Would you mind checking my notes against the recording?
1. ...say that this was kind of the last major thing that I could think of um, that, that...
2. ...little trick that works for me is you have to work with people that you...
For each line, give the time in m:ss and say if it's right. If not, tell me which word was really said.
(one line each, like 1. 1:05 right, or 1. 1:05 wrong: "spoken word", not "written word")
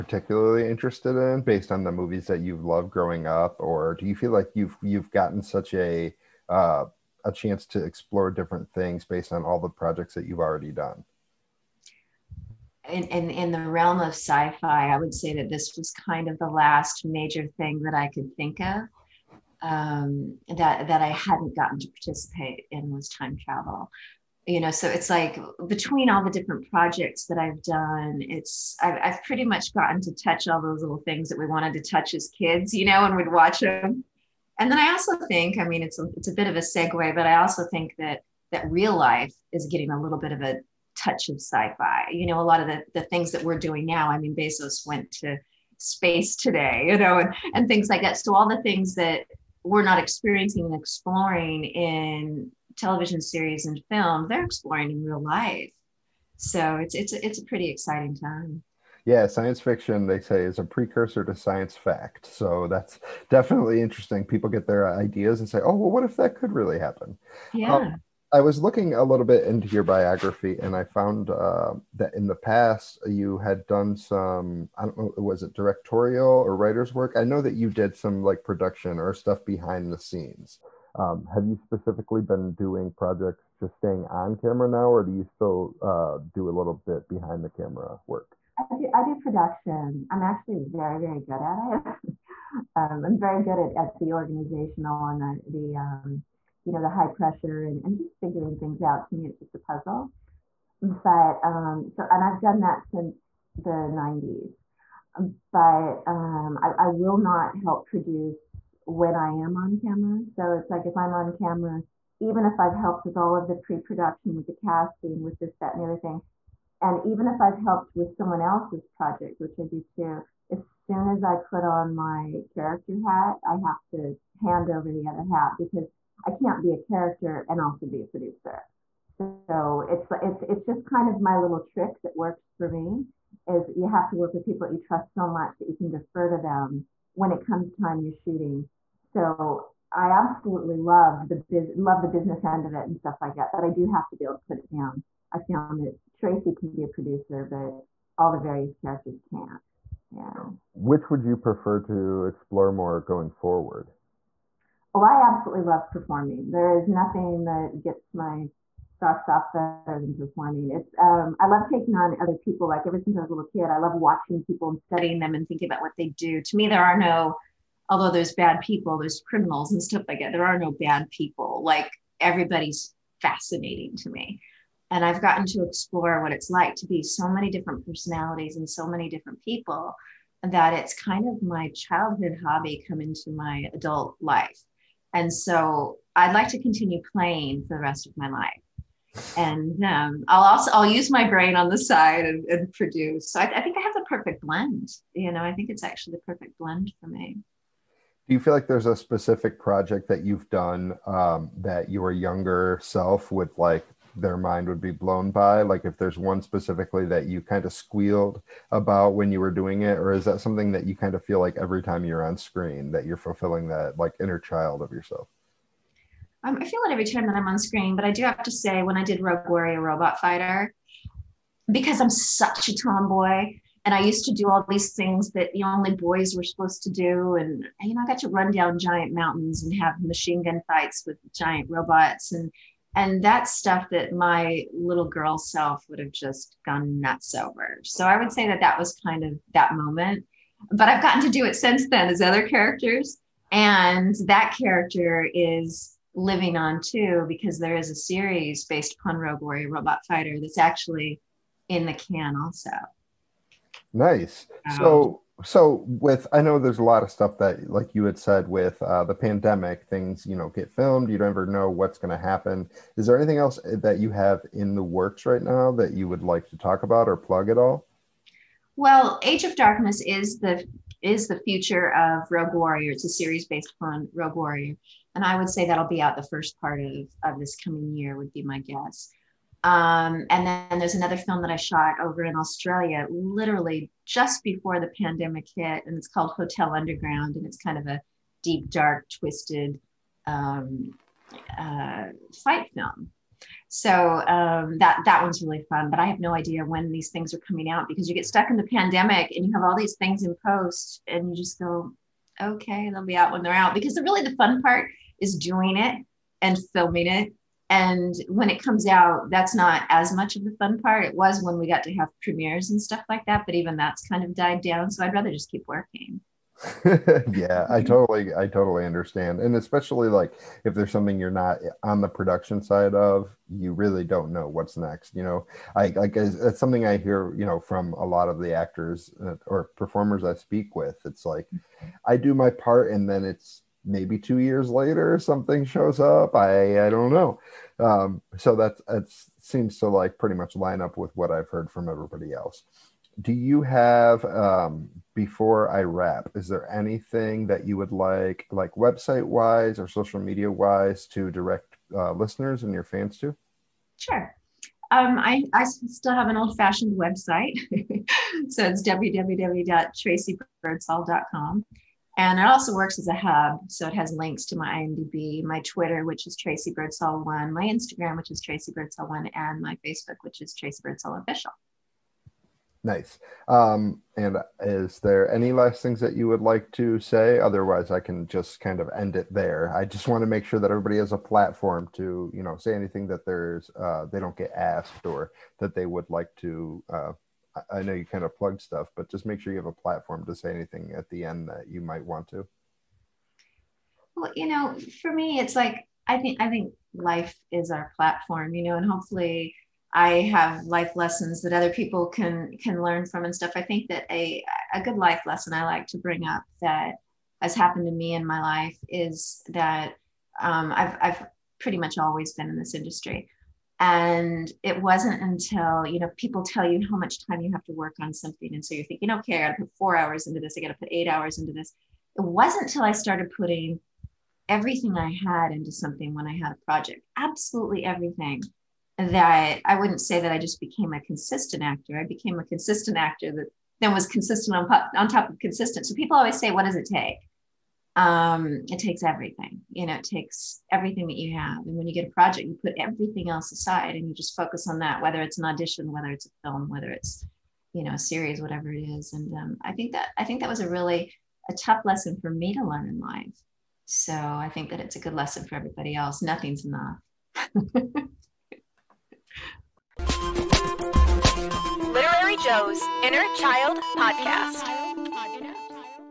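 1. 0:15 right
2. 2:11 right.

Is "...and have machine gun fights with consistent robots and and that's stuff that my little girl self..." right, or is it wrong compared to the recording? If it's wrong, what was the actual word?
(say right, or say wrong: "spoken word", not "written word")
wrong: "giant", not "consistent".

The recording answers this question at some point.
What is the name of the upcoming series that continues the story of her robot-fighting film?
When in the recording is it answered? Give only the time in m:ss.
4:29.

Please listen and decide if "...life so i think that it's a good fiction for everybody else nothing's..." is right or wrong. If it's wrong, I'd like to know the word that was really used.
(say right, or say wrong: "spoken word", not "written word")
wrong: "lesson", not "fiction".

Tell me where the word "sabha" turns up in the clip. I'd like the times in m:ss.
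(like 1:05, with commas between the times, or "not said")
not said.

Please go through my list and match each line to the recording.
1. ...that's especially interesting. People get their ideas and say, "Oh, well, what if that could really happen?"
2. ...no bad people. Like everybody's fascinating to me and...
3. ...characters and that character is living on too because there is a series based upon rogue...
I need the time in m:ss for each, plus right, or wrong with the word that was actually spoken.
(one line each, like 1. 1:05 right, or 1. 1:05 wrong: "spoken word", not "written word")
1. 1:02 wrong: "definitely", not "especially"
2. 2:50 right
3. 4:02 right.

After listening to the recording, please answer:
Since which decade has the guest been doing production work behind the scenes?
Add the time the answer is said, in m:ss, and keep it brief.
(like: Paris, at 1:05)
The 90s, at 1:43.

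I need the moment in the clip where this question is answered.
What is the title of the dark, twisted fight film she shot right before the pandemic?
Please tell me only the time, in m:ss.
4:46.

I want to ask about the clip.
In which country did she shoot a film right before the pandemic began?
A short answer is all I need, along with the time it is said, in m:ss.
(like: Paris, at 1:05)
Australia, at 4:42.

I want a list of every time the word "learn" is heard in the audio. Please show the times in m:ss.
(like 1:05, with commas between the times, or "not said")
6:42, 7:32.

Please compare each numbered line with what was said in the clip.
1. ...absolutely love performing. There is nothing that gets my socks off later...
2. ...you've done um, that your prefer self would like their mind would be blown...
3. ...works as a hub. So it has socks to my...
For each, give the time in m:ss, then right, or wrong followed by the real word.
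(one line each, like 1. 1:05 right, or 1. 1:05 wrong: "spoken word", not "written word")
1. 2:35 wrong: "better", not "later"
2. 3:20 wrong: "younger", not "prefer"
3. 6:02 wrong: "links", not "socks".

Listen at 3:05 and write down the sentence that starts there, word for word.
And so I'd like to continue playing for the rest of my life.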